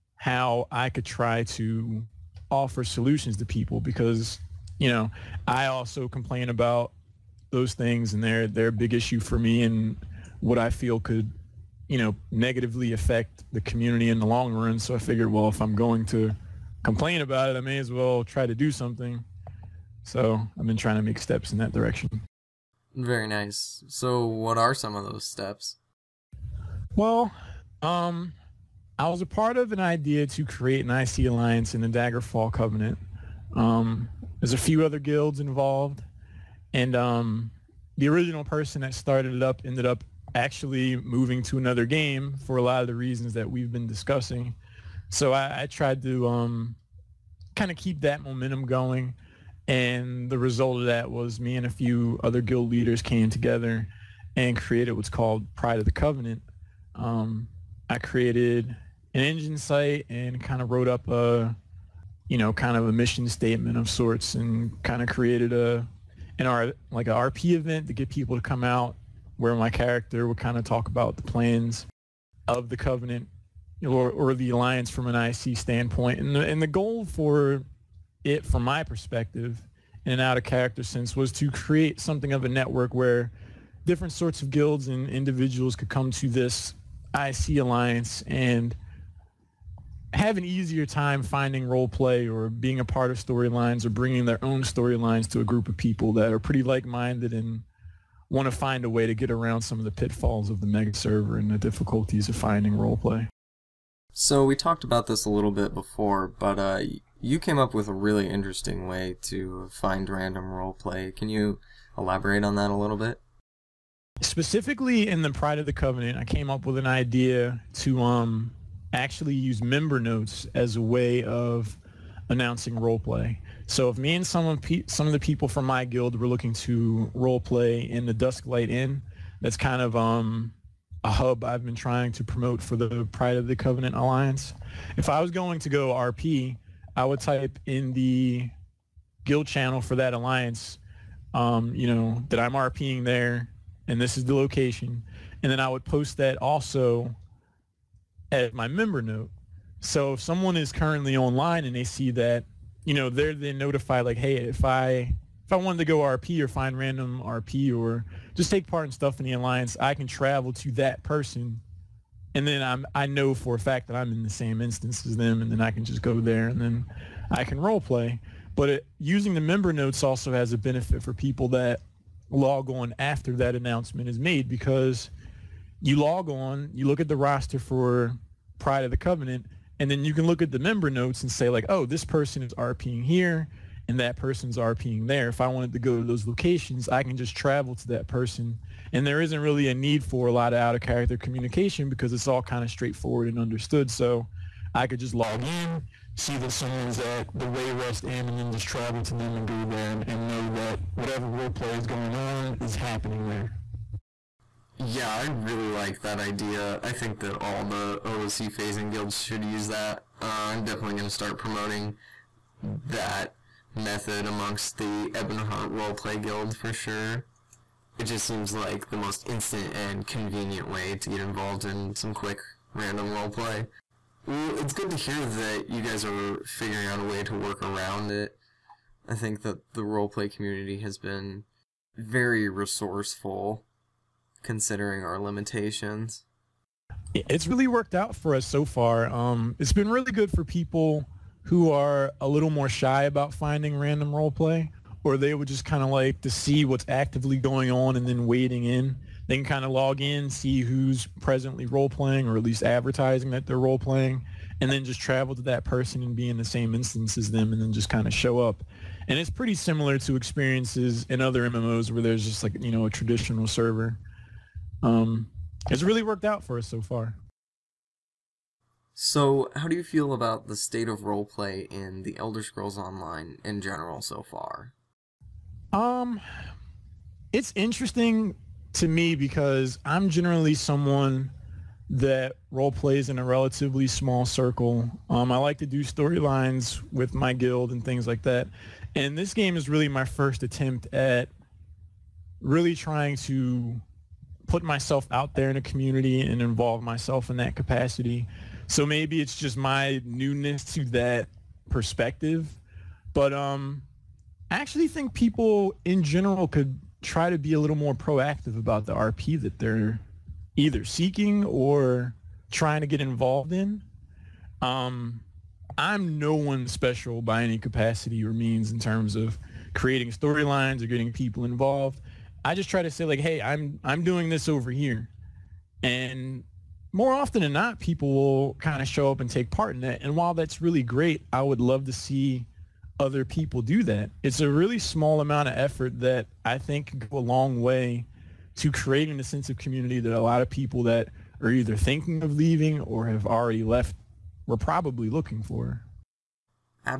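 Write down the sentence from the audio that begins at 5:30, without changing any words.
And while that's really great, I would love to see other people do that.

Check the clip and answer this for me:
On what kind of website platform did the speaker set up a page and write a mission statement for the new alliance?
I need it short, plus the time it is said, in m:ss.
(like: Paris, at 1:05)
Enjin, at 0:59.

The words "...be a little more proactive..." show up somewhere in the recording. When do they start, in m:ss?
5:07.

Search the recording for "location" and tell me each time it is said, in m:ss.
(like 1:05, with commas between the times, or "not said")
2:24, 3:06.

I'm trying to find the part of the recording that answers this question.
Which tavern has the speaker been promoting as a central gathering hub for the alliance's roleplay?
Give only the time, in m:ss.
2:08.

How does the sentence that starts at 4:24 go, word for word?
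Um, it's really worked out for us so far.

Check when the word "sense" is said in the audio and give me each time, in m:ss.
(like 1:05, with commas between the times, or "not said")
1:20, 5:39.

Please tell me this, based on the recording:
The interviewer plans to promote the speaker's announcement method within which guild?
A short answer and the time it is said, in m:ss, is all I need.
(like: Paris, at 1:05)
Ebonheart Roleplay Guild, at 3:35.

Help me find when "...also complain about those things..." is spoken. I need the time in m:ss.
0:05.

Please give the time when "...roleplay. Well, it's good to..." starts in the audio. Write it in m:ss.
3:43.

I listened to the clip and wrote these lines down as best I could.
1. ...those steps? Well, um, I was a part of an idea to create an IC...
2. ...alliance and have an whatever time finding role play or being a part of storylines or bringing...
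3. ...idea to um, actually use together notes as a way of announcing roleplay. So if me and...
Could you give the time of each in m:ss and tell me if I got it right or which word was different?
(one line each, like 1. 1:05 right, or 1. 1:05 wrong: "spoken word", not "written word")
1. 0:25 right
2. 1:27 wrong: "easier", not "whatever"
3. 1:56 wrong: "member", not "together".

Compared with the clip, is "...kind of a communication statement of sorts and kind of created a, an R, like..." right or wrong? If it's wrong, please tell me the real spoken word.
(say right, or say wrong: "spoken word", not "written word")
wrong: "mission", not "communication".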